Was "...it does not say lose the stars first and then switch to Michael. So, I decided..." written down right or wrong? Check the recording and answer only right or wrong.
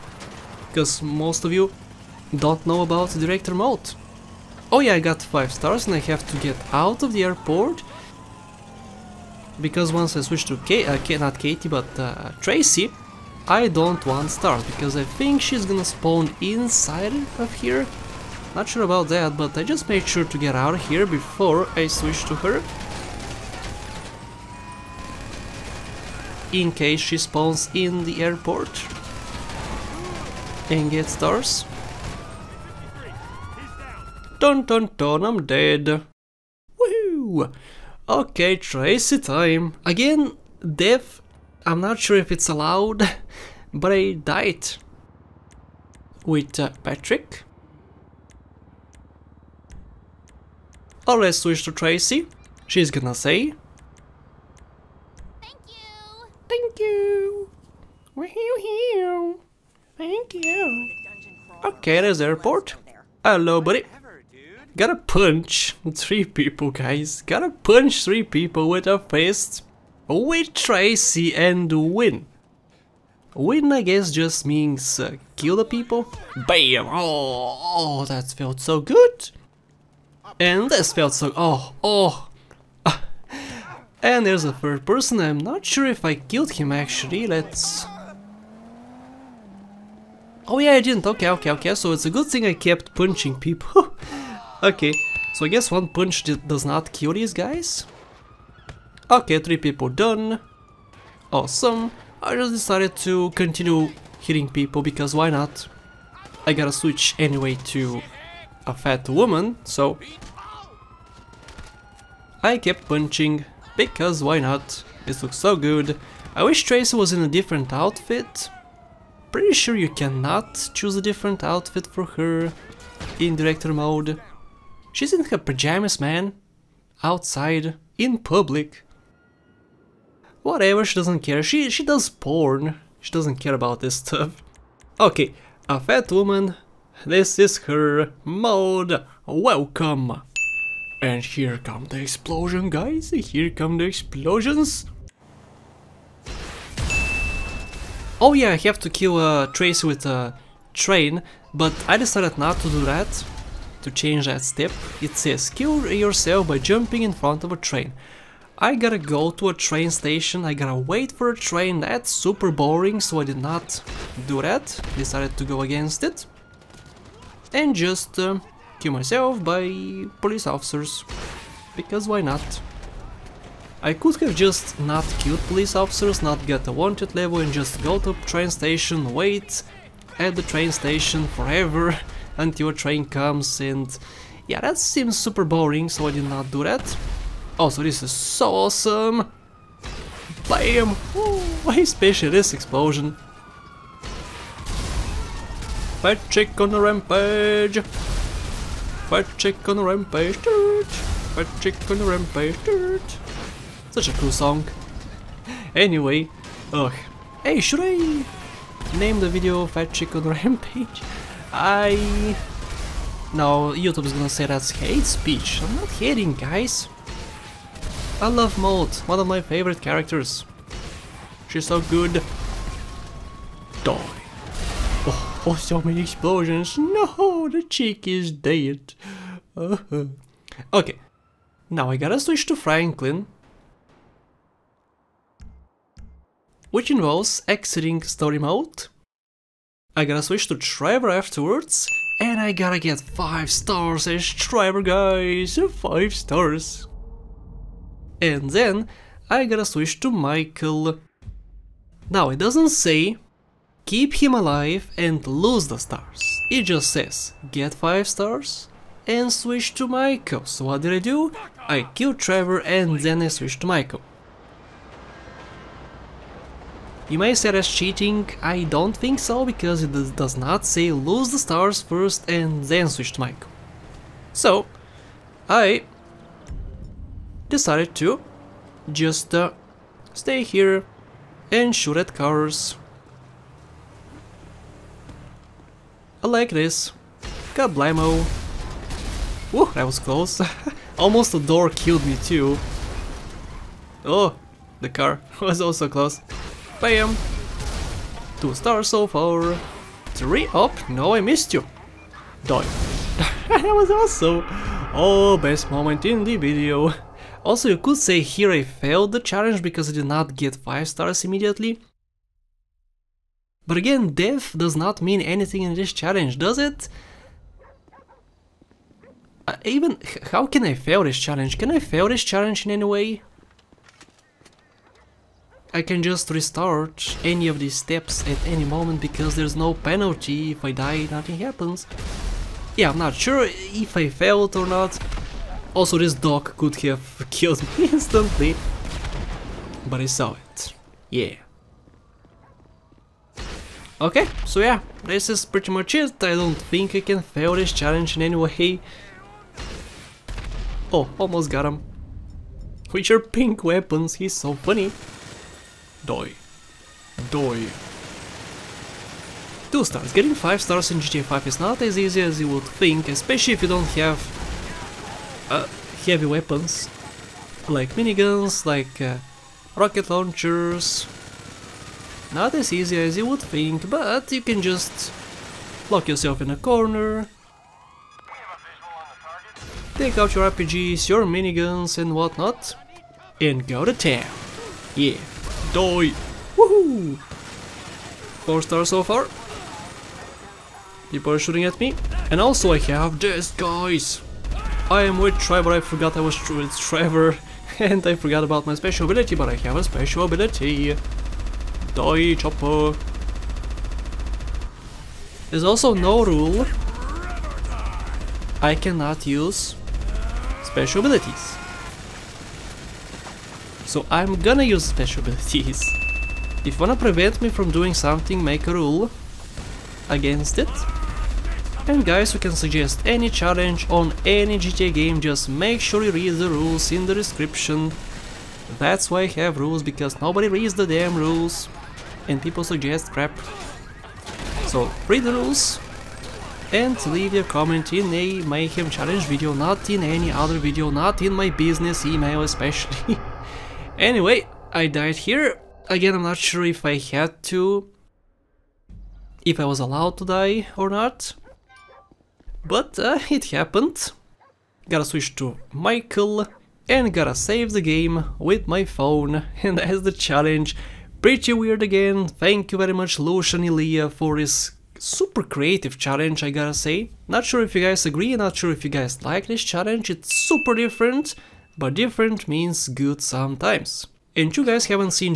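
right.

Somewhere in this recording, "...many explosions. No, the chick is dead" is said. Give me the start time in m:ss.
3:45.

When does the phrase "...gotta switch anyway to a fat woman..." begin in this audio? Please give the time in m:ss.
1:46.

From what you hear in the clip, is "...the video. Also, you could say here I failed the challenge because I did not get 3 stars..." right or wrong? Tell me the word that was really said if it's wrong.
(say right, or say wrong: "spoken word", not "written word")
wrong: "5", not "3".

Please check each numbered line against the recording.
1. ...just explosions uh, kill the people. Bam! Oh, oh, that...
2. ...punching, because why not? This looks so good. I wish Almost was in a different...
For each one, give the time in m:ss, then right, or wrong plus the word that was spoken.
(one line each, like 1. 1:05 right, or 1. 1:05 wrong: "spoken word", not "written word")
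1. 1:14 wrong: "means", not "explosions"
2. 1:52 wrong: "Tracey", not "Almost".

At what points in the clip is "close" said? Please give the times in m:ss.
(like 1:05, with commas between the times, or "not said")
4:49, 4:55.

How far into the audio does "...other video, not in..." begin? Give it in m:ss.
7:20.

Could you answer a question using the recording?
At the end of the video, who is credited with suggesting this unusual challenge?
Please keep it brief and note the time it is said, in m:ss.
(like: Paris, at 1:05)
Lucian Ilea, at 7:43.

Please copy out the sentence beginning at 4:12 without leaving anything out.
Now it doesn't say keep him alive and lose the stars, it just says get 5 stars and switch to Michael.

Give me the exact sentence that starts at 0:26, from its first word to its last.
In case she spawns in the airport and gets stars.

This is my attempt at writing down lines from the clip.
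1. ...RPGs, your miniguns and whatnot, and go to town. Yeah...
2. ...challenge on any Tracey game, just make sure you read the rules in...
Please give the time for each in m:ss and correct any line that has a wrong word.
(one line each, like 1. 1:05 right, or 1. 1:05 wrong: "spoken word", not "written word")
1. 6:20 right
2. 7:03 wrong: "GTA", not "Tracey".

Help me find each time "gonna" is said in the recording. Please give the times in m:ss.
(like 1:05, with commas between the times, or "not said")
0:15, 0:52, 3:33, 6:54.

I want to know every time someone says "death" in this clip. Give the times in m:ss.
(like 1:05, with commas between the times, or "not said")
0:40, 5:14.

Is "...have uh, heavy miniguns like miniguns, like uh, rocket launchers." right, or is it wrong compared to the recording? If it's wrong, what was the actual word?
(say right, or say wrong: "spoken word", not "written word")
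wrong: "weapons", not "miniguns".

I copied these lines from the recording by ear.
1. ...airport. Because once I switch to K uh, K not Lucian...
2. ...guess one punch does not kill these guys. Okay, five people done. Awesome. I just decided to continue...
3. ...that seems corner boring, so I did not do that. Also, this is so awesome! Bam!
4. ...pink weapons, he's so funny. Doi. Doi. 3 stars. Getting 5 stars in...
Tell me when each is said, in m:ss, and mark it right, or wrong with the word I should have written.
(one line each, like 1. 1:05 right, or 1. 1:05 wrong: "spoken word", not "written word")
1. 0:07 wrong: "Katie", not "Lucian"
2. 1:35 wrong: "three", not "five"
3. 3:04 wrong: "super", not "corner"
4. 5:53 wrong: "2", not "3".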